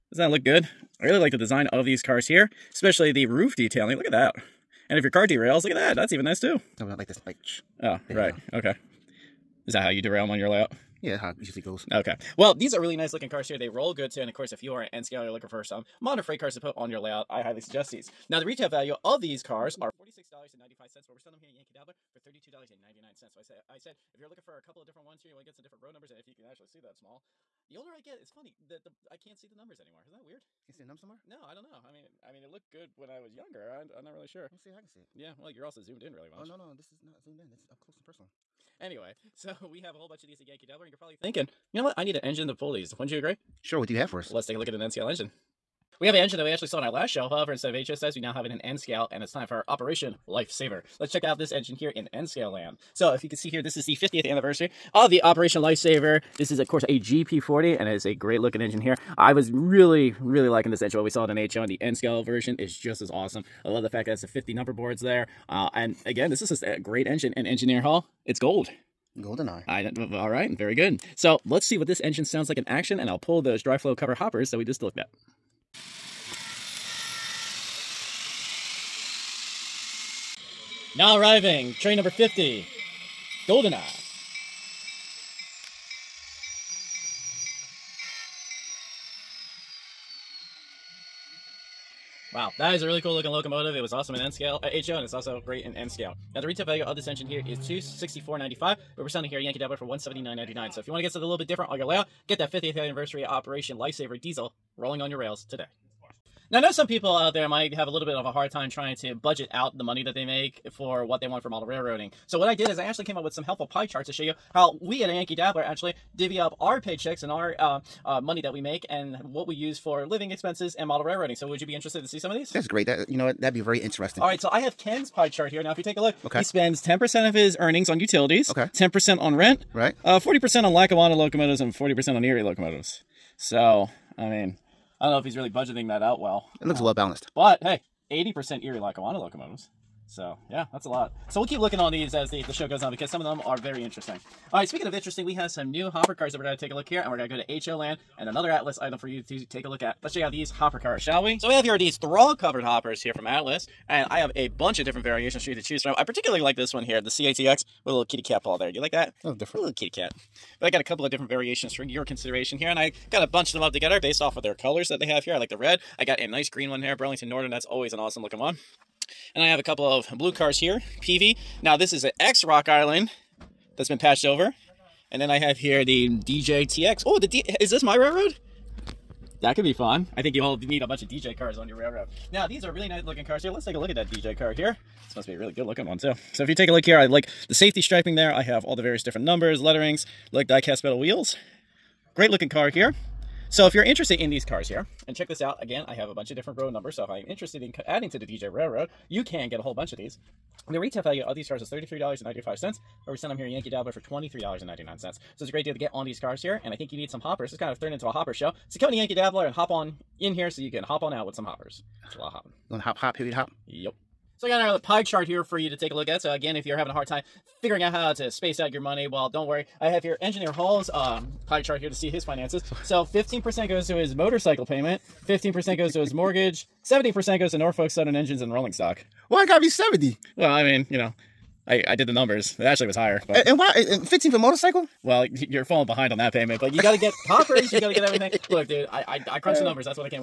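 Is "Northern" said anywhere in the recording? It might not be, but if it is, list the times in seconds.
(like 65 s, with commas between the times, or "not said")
167 s.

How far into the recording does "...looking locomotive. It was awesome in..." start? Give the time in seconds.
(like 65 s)
93 s.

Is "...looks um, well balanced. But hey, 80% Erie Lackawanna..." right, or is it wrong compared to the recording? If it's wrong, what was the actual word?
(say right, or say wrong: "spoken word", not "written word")
right.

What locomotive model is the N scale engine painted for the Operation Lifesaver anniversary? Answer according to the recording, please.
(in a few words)
GP40.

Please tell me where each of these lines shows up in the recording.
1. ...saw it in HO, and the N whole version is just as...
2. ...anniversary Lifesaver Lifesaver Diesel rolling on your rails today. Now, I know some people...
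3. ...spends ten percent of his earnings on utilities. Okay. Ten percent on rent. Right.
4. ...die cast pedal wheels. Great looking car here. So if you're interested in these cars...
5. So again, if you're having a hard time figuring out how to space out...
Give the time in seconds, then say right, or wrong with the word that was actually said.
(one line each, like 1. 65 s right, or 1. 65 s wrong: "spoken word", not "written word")
1. 61 s wrong: "scale", not "whole"
2. 102 s wrong: "Operation", not "Lifesaver"
3. 126 s right
4. 190 s right
5. 216 s right.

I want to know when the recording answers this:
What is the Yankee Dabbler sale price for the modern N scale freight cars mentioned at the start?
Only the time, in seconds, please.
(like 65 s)
22 s.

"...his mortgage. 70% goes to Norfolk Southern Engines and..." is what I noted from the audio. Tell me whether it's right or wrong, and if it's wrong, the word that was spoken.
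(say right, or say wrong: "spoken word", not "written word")
right.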